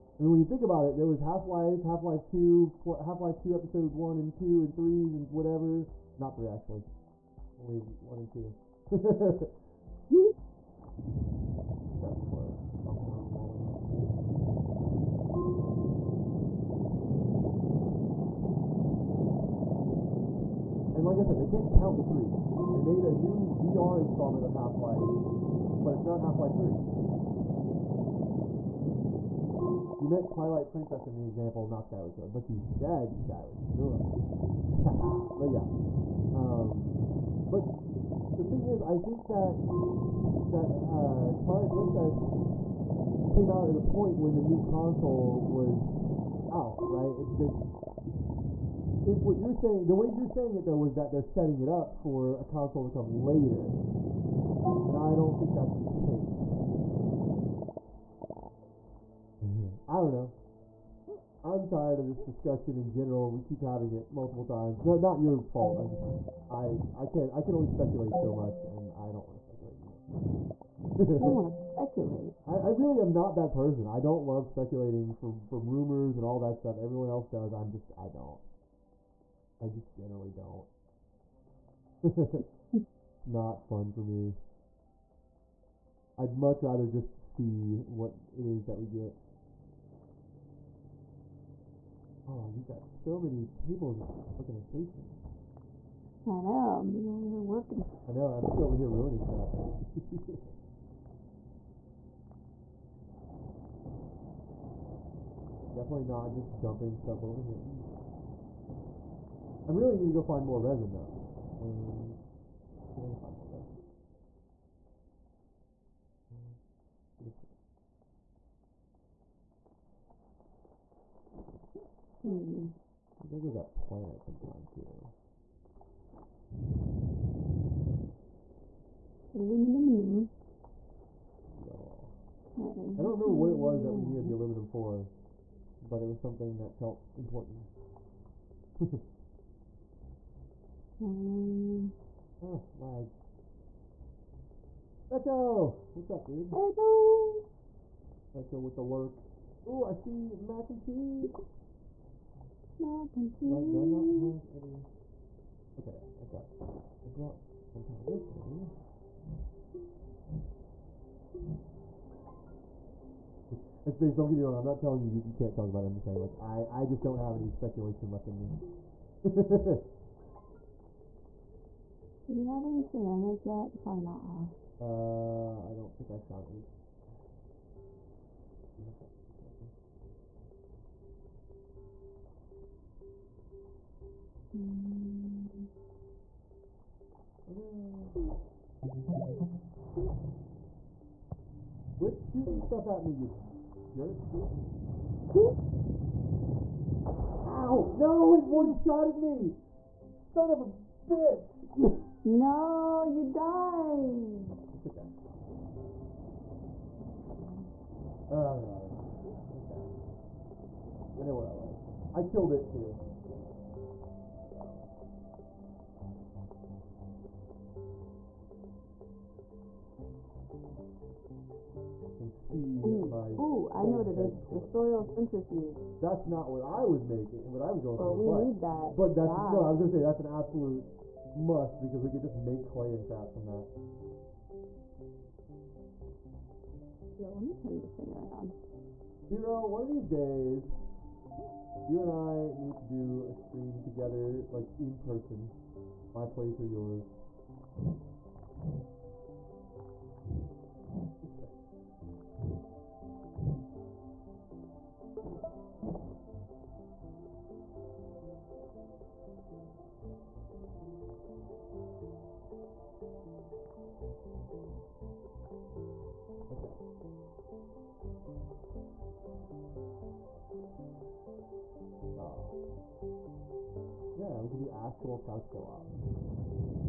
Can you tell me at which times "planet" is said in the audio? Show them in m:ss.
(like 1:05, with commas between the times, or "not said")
2:03.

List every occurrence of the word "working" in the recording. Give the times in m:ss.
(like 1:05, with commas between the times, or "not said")
1:37.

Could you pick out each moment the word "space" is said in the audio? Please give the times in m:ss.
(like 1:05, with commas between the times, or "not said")
2:43.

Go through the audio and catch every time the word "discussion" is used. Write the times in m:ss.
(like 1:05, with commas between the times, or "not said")
1:02.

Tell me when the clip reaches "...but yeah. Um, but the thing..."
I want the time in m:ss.
0:35.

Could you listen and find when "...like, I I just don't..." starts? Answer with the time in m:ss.
2:46.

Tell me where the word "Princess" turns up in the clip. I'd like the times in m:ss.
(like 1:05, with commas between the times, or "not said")
0:30, 0:41.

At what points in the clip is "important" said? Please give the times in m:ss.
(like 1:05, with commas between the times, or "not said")
2:17.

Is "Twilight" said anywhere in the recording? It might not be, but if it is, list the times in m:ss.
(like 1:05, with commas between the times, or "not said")
0:30, 0:41.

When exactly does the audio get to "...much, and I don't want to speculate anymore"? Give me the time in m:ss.
1:08.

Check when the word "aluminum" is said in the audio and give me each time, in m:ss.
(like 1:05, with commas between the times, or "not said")
2:09, 2:14.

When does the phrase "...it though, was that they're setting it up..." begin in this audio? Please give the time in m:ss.
0:50.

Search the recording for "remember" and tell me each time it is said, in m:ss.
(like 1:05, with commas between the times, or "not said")
2:13.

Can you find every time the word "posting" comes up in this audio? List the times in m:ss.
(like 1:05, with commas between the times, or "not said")
not said.